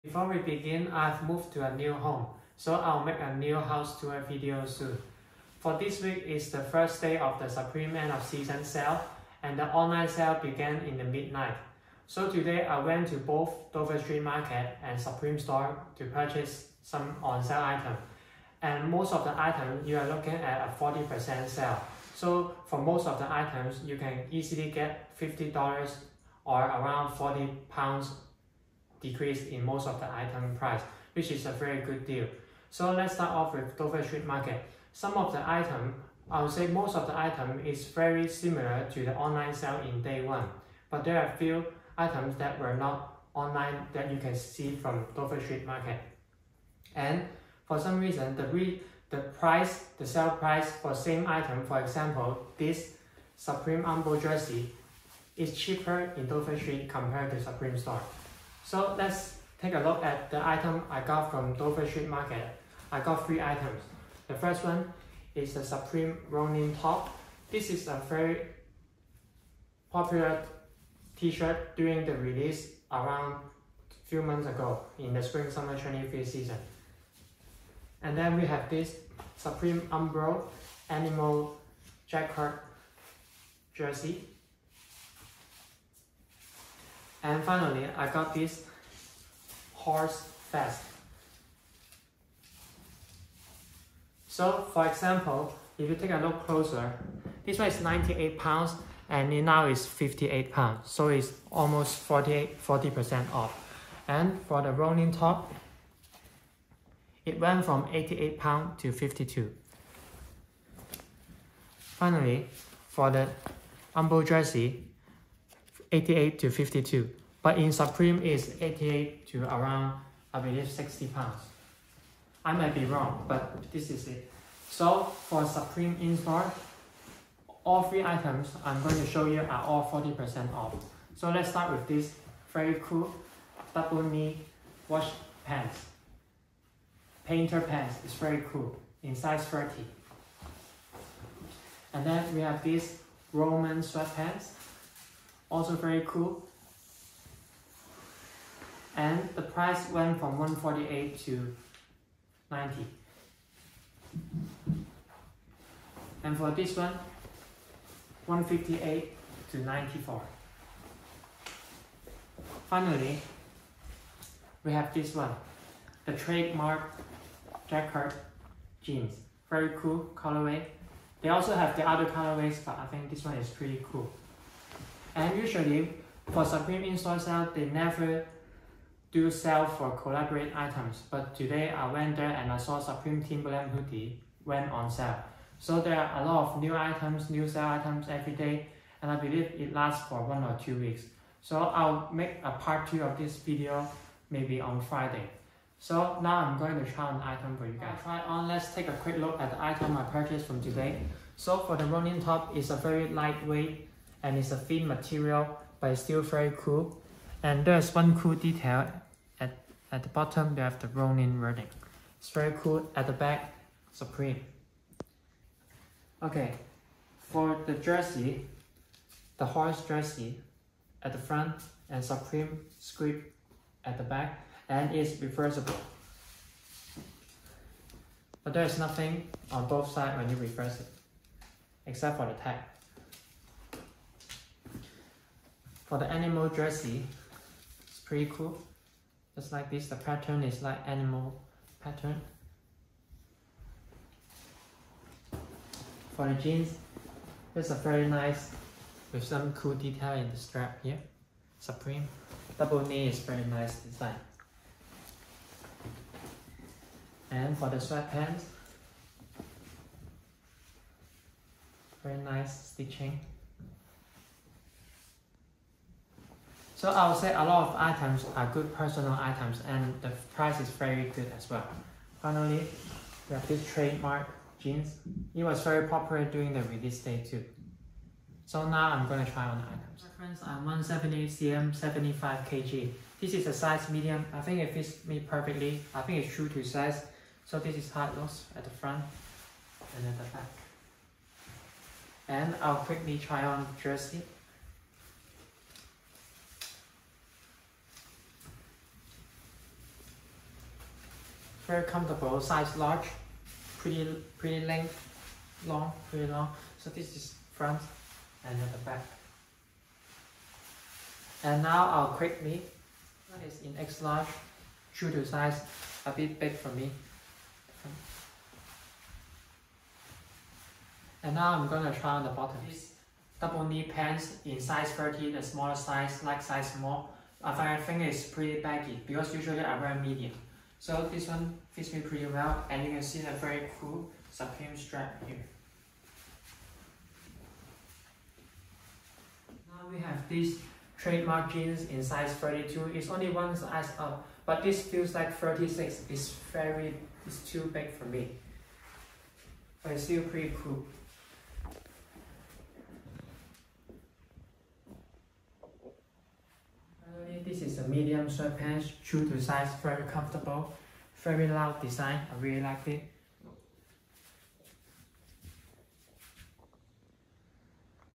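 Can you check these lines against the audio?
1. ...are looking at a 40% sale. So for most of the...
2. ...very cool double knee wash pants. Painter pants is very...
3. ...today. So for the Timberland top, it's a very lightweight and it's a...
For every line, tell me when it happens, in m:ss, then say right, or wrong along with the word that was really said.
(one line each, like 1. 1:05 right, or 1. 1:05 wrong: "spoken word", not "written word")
1. 0:19 right
2. 2:12 right
3. 3:20 wrong: "Ronin", not "Timberland".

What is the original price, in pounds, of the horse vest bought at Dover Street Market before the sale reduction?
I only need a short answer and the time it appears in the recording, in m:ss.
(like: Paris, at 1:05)
98, at 1:37.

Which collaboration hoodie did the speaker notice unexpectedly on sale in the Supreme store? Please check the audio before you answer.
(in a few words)
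Supreme Timberland hoodie.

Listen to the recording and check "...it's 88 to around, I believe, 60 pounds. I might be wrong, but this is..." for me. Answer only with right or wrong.
right.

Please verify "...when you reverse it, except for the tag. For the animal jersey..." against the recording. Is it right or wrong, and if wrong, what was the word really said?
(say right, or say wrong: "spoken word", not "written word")
right.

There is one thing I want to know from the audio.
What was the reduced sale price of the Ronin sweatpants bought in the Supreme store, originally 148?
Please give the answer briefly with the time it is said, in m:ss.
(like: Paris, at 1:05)
90, at 2:31.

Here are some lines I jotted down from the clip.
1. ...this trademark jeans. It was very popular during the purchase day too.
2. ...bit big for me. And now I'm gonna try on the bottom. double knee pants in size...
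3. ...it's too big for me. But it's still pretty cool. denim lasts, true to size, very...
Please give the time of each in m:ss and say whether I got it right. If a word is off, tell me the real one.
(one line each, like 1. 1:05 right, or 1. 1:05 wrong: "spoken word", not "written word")
1. 4:33 wrong: "release", not "purchase"
2. 5:16 right
3. 5:47 wrong: "sweatpants", not "lasts".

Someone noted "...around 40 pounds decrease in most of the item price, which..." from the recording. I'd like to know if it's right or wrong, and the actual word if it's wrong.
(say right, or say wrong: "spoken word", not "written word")
right.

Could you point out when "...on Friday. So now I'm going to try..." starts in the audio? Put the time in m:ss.
3:14.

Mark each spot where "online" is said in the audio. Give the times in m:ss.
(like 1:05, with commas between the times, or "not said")
0:09, 0:39, 0:43.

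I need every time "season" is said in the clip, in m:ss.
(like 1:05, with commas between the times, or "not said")
0:08, 1:16.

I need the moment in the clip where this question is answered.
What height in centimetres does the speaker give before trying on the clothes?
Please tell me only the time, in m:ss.
4:40.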